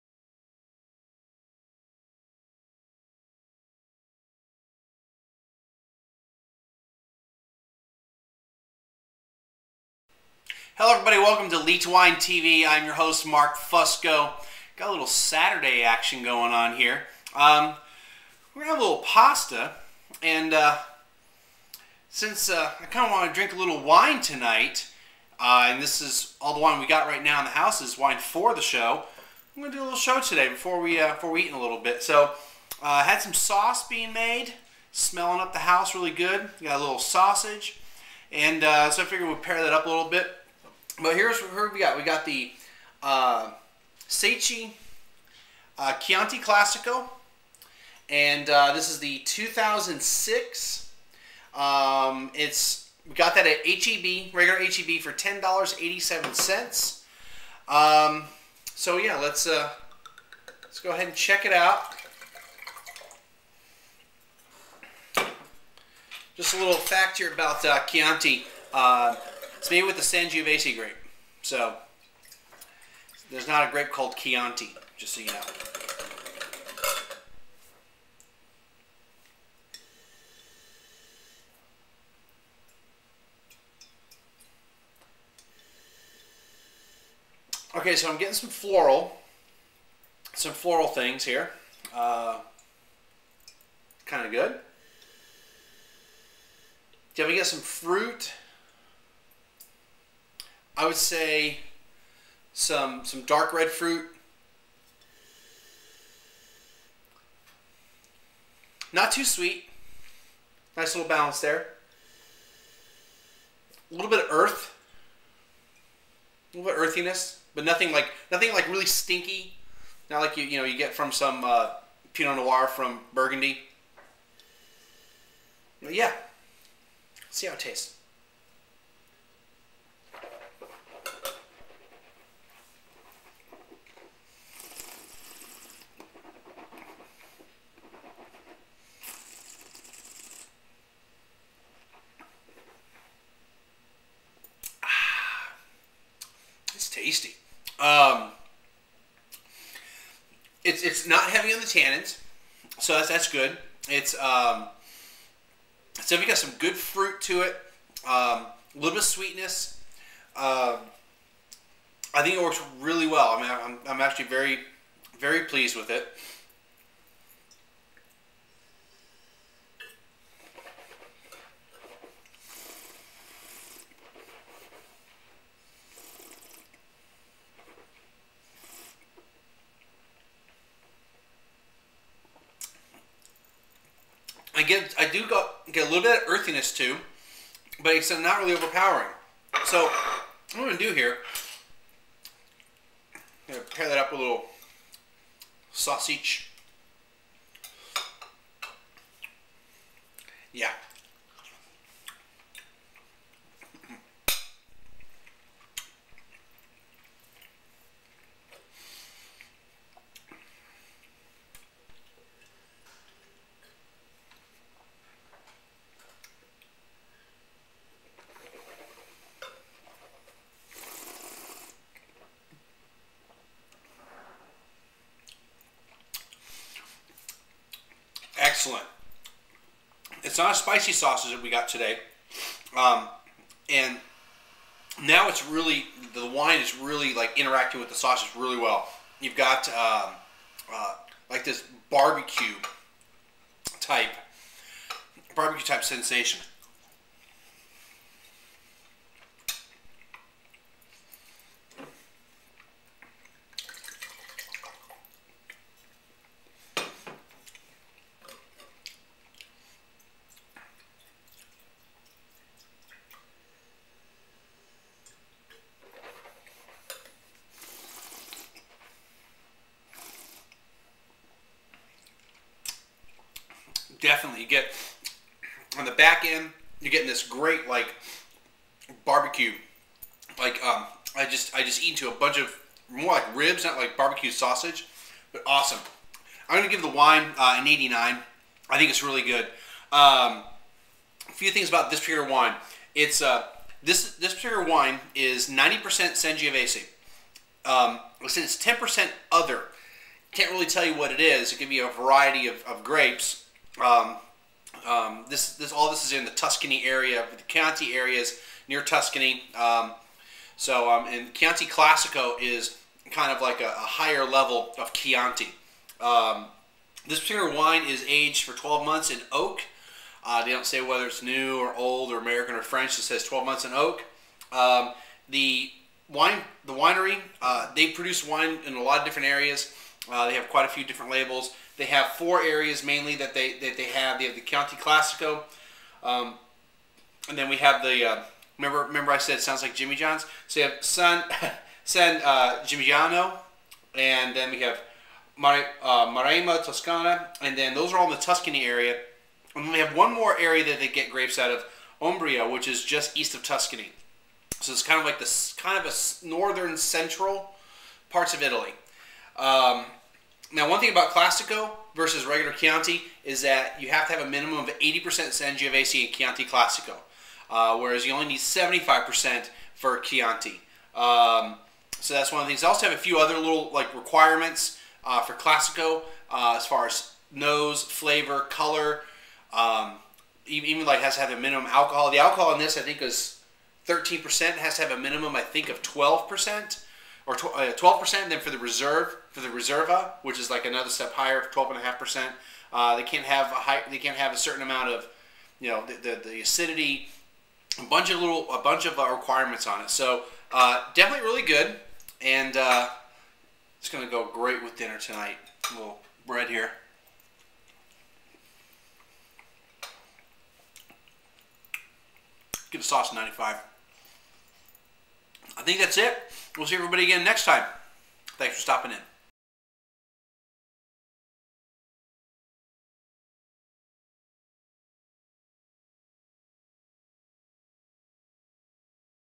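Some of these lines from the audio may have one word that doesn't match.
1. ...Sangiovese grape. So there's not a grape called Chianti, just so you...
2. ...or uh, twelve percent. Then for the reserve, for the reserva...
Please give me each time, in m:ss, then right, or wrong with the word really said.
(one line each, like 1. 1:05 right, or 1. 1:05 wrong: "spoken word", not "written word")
1. 1:10 right
2. 6:27 right.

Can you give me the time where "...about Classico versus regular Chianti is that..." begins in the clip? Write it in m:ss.
6:00.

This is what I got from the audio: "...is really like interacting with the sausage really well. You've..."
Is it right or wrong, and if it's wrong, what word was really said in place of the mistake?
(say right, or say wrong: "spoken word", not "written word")
right.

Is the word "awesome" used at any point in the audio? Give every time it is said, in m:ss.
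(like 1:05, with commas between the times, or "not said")
4:45.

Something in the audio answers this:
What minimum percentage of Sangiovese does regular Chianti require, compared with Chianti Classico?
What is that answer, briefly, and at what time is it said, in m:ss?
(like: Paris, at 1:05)
75%, at 6:08.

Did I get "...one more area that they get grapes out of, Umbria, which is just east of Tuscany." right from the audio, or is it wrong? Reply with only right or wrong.
right.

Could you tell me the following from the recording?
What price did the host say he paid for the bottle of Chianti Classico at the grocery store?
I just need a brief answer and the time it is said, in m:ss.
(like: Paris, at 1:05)
$10.87, at 0:55.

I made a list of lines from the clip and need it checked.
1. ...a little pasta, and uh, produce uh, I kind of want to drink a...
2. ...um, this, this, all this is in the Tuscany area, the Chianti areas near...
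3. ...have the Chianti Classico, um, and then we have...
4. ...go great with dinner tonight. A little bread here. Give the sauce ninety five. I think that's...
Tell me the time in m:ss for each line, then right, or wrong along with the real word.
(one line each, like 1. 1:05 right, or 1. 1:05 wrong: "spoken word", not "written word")
1. 0:18 wrong: "since", not "produce"
2. 5:04 right
3. 5:34 right
4. 6:44 right.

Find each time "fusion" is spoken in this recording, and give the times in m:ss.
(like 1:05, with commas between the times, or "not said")
not said.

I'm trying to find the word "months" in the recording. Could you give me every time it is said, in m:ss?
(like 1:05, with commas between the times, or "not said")
5:18, 5:23.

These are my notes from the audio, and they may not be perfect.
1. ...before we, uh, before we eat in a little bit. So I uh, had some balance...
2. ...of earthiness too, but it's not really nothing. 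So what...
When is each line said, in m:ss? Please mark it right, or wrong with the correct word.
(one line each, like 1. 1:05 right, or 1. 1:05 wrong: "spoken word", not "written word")
1. 0:30 wrong: "sauce", not "balance"
2. 3:06 wrong: "overpowering", not "nothing".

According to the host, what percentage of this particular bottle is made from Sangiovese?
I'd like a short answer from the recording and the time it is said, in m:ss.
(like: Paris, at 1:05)
90%, at 4:55.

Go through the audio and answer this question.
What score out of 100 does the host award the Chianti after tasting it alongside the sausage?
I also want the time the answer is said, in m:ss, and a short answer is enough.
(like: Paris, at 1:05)
89, at 4:47.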